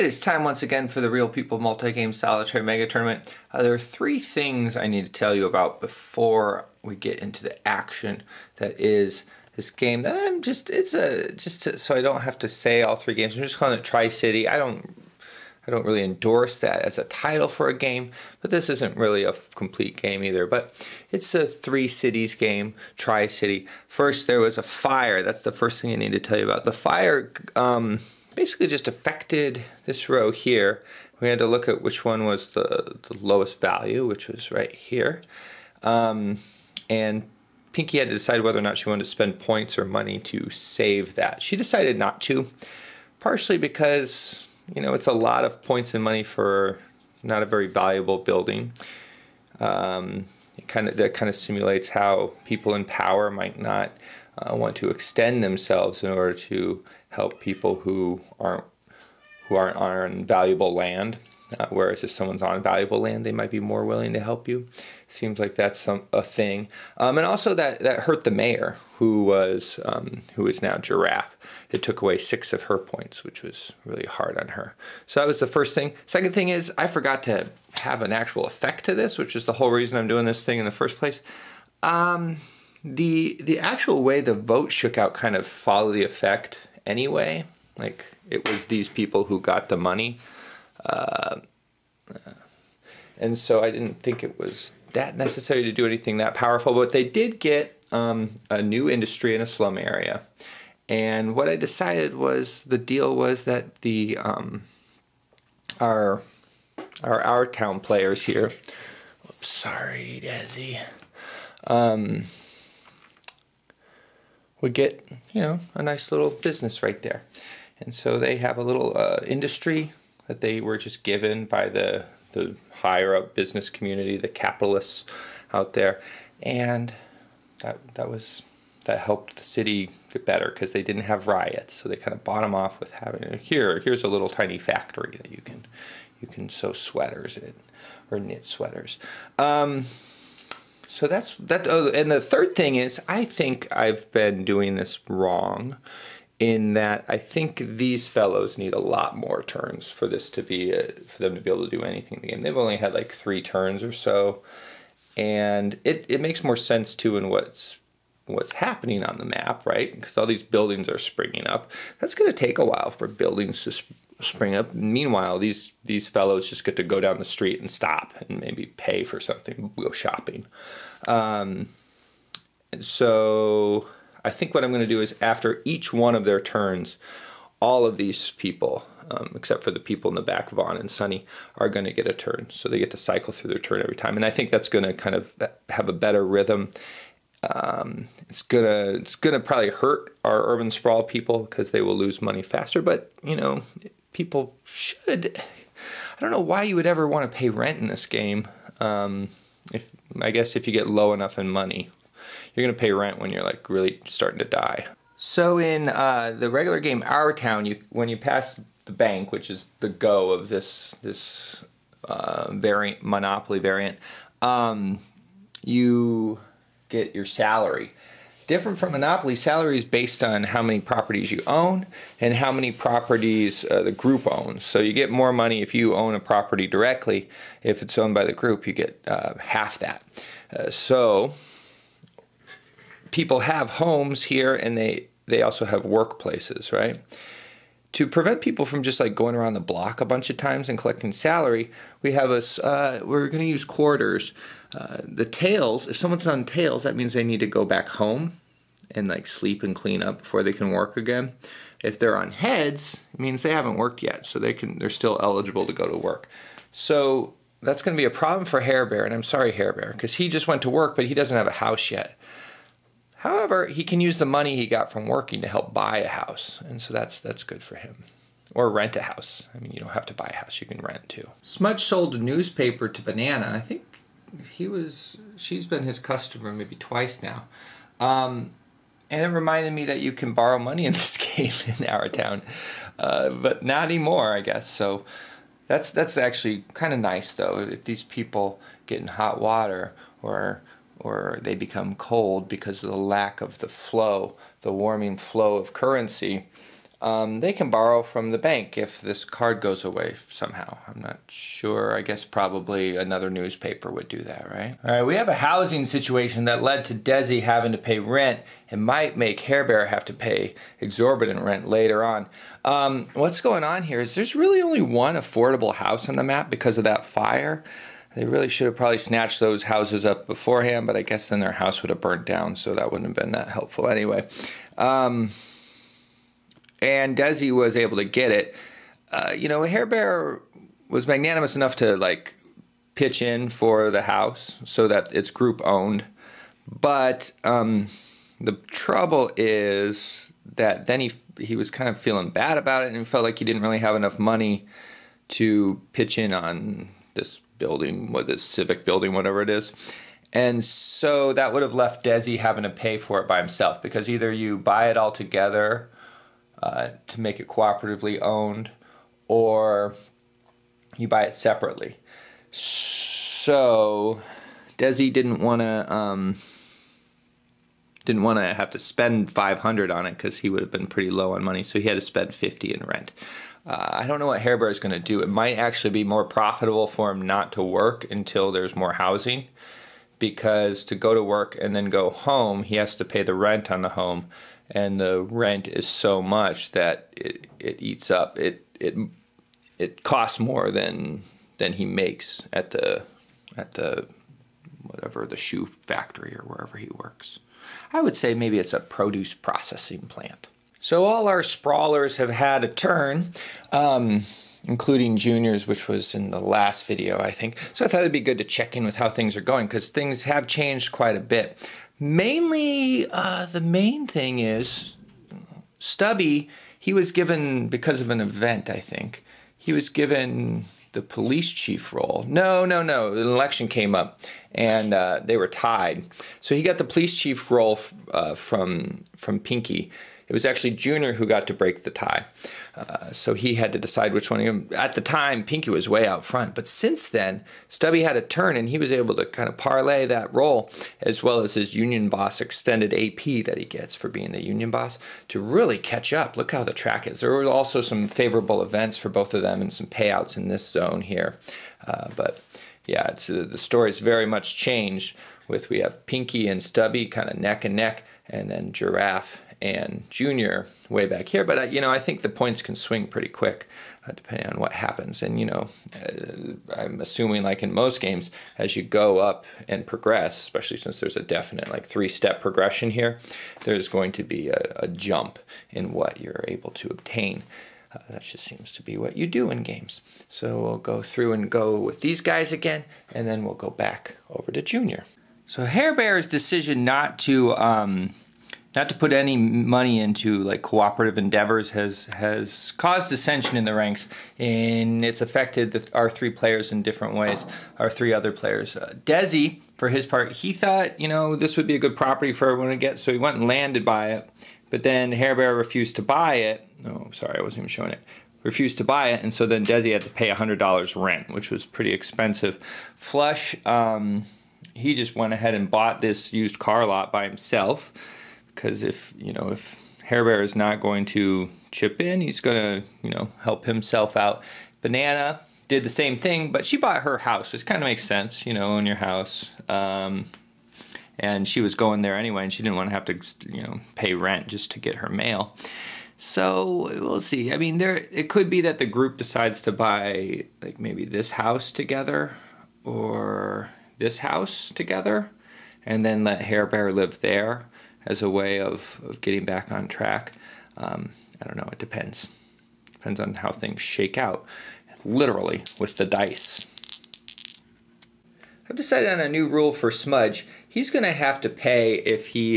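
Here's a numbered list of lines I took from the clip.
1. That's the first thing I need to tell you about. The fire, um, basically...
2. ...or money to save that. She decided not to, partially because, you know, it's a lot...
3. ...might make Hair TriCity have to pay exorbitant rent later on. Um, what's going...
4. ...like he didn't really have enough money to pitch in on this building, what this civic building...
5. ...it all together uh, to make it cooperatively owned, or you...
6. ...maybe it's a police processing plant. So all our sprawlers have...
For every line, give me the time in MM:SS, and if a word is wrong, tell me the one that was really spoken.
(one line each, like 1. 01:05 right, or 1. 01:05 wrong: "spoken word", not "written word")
1. 00:25 right
2. 00:39 right
3. 05:08 wrong: "Bear", not "TriCity"
4. 05:43 right
5. 05:54 right
6. 06:38 wrong: "produce", not "police".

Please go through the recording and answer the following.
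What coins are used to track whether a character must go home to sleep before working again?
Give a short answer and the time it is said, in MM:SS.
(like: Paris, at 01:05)
quarters, at 04:03.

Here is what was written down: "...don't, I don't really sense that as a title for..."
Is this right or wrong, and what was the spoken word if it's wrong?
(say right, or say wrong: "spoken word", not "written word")
wrong: "endorse", not "sense".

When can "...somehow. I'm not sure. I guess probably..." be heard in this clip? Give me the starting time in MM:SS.
05:00.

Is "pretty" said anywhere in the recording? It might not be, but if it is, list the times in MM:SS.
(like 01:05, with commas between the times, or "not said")
06:10, 07:43, 08:31.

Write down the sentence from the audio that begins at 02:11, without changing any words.
So they kind of bought them off with having here.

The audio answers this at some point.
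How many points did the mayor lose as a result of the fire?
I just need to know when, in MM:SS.
01:12.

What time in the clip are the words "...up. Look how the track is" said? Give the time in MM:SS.
07:26.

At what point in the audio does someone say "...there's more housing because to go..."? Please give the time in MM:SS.
06:18.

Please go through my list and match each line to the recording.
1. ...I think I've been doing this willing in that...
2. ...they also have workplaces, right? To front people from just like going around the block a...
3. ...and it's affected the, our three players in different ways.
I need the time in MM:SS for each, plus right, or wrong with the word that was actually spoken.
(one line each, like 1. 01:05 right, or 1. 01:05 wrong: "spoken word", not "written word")
1. 02:23 wrong: "wrong", not "willing"
2. 03:55 wrong: "prevent", not "front"
3. 08:14 right.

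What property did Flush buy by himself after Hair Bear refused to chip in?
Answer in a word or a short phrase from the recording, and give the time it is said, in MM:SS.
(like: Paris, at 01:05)
used car lot, at 08:36.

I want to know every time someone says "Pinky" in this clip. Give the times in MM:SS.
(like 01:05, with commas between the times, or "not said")
00:37, 07:09, 07:15, 07:36.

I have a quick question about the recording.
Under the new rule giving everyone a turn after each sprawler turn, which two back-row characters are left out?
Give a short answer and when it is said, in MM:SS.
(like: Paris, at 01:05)
Vaughn and Sunny, at 03:00.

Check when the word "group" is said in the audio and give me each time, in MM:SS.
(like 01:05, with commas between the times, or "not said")
03:43, 03:48, 05:35, 08:58.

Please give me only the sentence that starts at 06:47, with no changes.
So I thought it'd be good to check in with how things are going because things have changed quite a bit.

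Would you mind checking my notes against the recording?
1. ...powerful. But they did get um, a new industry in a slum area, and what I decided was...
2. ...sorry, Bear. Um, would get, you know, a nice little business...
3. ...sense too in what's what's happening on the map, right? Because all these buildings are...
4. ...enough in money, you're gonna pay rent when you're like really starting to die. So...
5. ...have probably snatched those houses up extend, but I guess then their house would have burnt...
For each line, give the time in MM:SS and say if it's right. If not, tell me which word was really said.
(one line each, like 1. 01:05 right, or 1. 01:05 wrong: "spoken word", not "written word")
1. 01:36 right
2. 01:49 wrong: "Desi", not "Bear"
3. 02:36 right
4. 03:21 right
5. 05:18 wrong: "beforehand", not "extend".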